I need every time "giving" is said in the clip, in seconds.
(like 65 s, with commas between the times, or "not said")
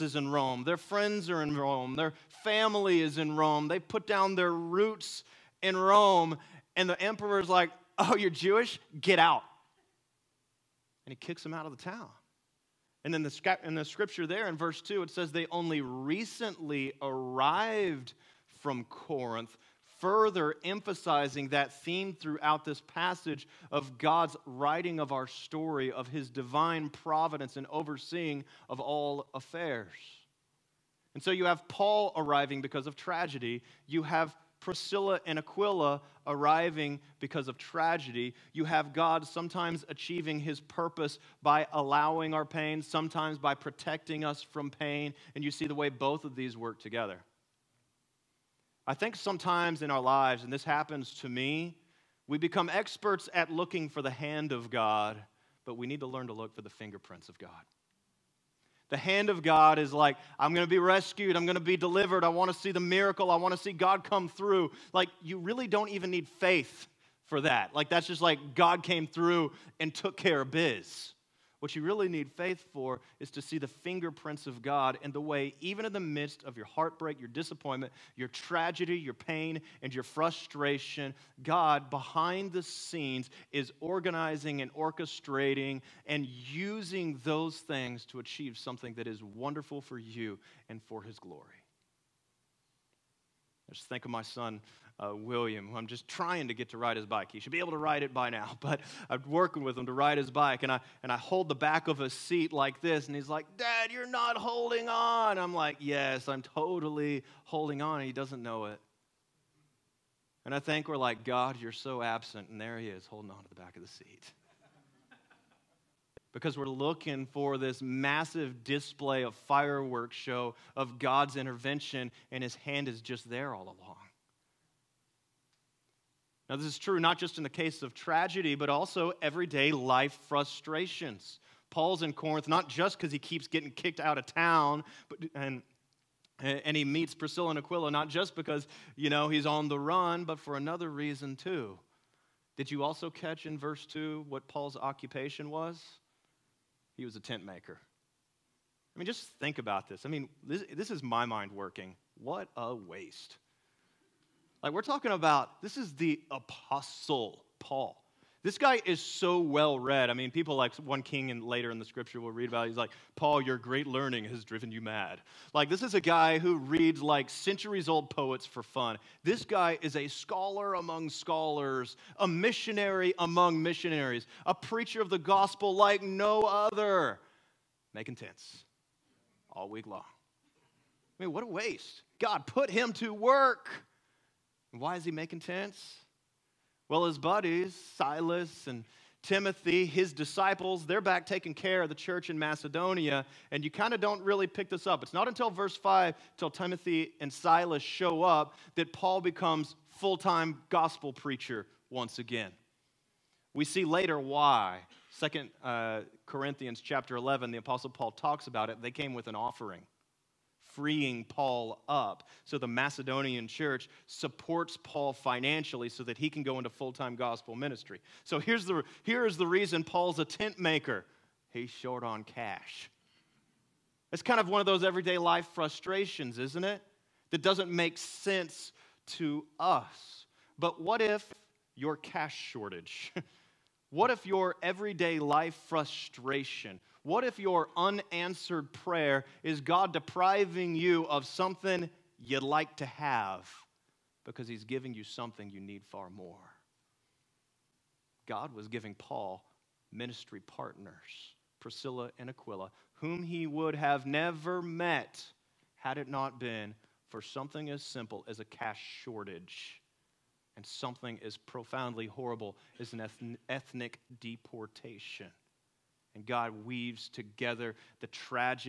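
244 s, 248 s.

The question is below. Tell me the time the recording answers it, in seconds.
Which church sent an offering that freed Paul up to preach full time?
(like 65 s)
212 s.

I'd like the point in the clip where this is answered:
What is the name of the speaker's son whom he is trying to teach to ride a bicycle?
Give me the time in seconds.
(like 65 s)
95 s.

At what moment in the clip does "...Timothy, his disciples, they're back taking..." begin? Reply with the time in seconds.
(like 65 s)
189 s.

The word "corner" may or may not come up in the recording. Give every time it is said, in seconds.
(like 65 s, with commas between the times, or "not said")
not said.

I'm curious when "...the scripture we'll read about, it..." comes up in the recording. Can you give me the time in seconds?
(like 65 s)
161 s.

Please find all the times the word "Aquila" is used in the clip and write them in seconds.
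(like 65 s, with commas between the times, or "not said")
35 s, 137 s, 252 s.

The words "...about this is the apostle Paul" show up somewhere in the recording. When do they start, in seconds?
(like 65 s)
155 s.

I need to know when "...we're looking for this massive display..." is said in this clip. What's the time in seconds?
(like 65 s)
116 s.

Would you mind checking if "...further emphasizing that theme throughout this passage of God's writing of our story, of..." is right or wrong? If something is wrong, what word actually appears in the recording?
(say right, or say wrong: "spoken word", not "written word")
right.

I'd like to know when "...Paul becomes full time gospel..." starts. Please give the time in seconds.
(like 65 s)
198 s.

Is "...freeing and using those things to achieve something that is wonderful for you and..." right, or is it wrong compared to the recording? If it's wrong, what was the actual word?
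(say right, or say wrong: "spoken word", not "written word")
wrong: "orchestrating", not "freeing".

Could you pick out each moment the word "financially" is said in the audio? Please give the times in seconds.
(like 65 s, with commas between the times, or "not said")
215 s.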